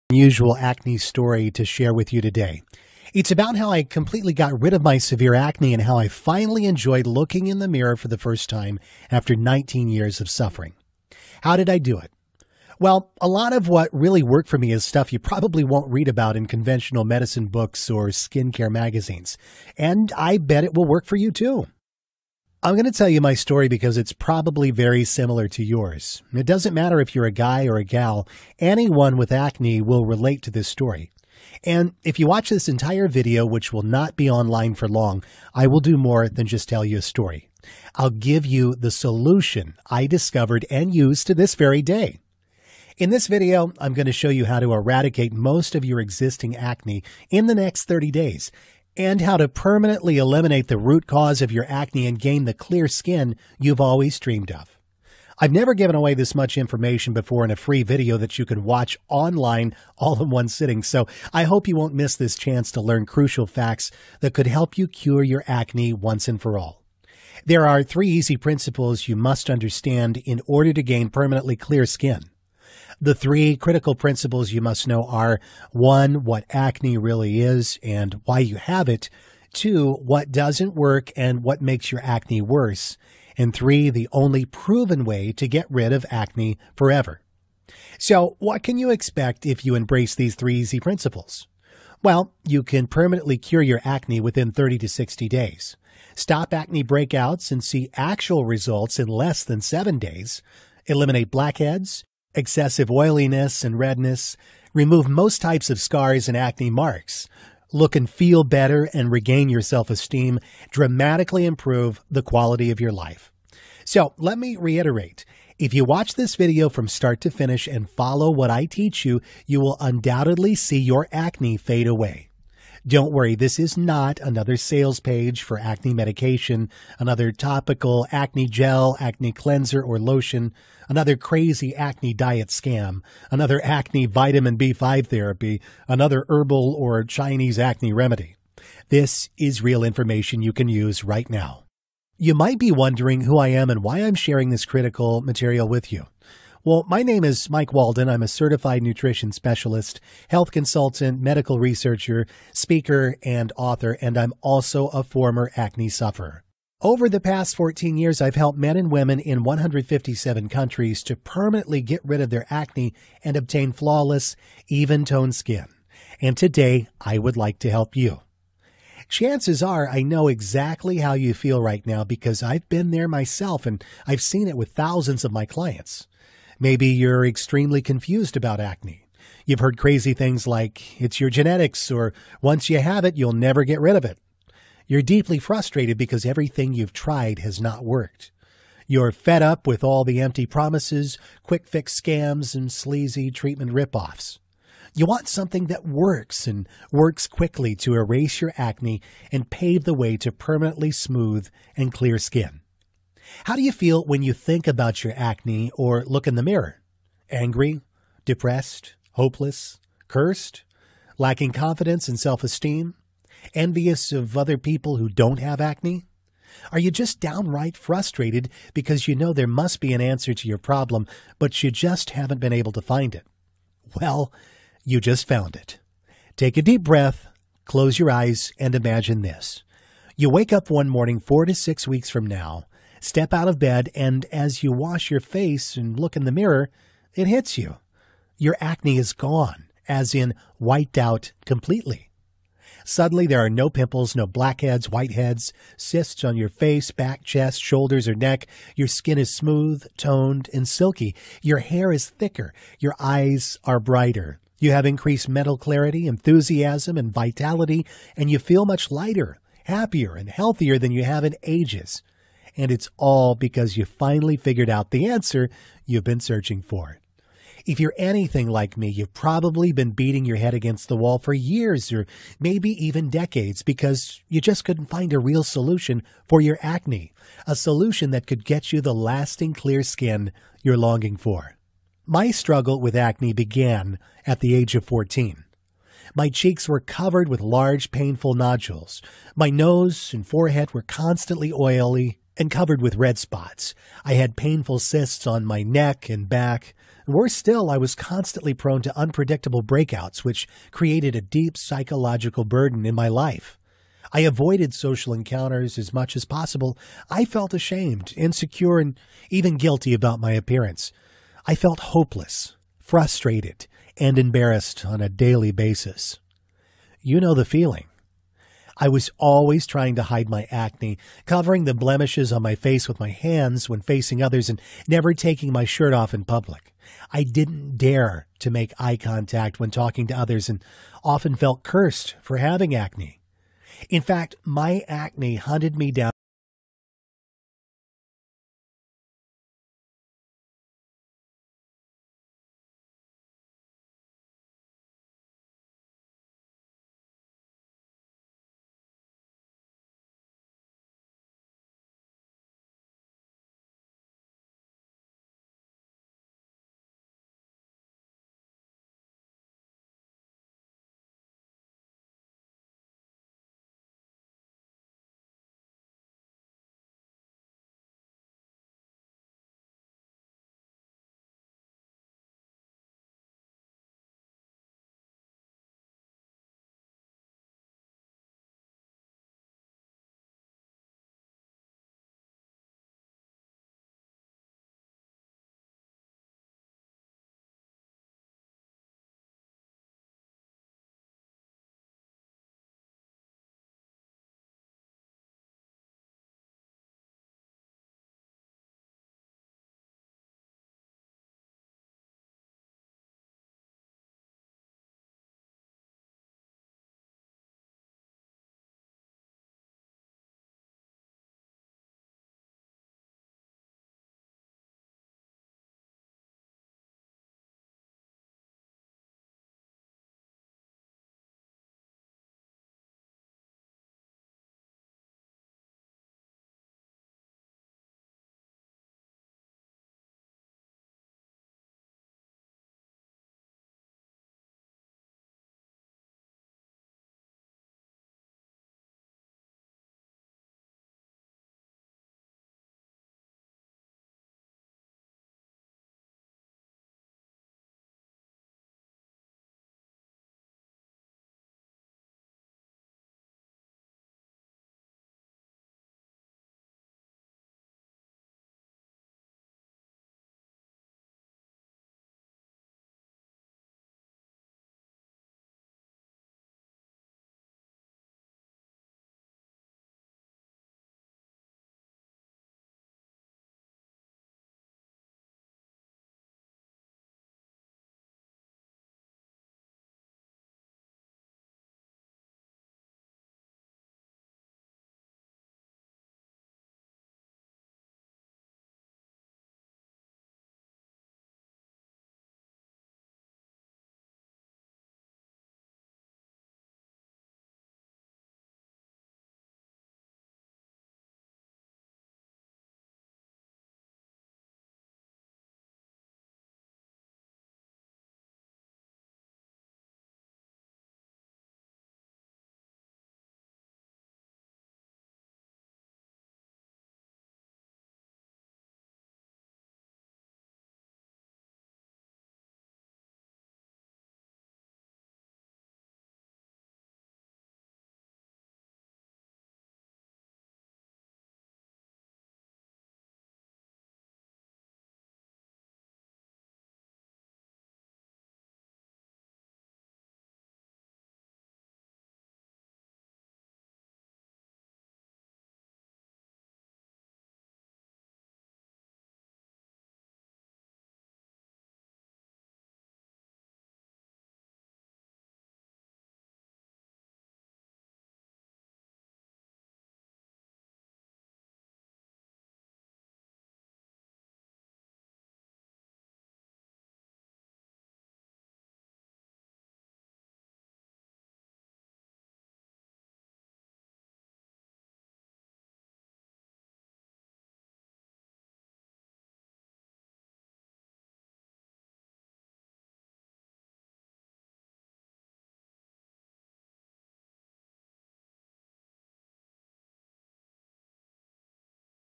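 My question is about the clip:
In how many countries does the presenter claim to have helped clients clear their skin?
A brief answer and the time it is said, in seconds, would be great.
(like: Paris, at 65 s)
157, at 159 s.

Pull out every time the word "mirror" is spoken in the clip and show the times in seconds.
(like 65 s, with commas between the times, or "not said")
7 s, 206 s, 236 s.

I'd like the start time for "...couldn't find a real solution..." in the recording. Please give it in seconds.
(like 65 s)
274 s.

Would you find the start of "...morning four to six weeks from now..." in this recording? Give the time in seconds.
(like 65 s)
230 s.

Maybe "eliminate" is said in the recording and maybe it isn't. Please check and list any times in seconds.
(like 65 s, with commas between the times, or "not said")
50 s, 100 s.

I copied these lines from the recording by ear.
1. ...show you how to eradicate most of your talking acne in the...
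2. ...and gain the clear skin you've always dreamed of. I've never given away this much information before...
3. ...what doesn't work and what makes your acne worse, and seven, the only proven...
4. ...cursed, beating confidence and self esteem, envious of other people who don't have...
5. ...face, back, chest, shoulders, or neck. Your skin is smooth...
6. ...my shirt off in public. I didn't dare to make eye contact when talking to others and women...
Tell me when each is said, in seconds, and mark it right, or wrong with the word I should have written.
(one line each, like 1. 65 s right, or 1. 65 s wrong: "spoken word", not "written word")
1. 44 s wrong: "existing", not "talking"
2. 52 s right
3. 79 s wrong: "three", not "seven"
4. 210 s wrong: "lacking", not "beating"
5. 246 s right
6. 325 s wrong: "often", not "women".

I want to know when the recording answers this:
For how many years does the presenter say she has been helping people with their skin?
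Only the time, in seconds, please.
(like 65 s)
157 s.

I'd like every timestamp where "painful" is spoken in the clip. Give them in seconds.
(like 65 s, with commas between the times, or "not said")
287 s, 294 s.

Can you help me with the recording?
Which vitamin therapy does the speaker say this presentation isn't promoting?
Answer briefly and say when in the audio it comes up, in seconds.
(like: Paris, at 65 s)
Vitamin B5, at 134 s.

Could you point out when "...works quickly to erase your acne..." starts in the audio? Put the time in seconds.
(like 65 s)
196 s.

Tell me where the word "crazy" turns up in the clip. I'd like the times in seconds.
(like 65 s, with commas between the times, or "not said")
131 s, 179 s.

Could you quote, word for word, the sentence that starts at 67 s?
There are three easy principles you must understand in order to gain permanently clear skin.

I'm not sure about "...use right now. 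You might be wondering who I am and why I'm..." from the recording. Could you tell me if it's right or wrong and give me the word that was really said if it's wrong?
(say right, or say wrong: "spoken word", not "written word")
right.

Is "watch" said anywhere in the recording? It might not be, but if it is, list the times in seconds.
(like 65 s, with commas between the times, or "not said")
32 s, 58 s, 115 s.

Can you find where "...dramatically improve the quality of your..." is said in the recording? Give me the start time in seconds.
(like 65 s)
110 s.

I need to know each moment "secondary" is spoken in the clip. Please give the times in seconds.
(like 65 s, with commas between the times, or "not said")
not said.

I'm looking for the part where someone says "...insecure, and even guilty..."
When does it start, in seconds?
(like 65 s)
308 s.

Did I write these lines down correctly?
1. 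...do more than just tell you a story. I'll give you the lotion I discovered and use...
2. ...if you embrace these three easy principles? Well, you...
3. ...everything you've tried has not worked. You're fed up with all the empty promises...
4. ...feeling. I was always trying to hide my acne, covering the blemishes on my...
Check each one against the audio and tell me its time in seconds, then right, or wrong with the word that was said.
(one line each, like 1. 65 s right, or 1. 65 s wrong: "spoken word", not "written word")
1. 35 s wrong: "solution", not "lotion"
2. 89 s right
3. 186 s right
4. 317 s right.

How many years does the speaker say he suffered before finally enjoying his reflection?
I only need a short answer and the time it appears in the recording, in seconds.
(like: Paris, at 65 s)
19, at 9 s.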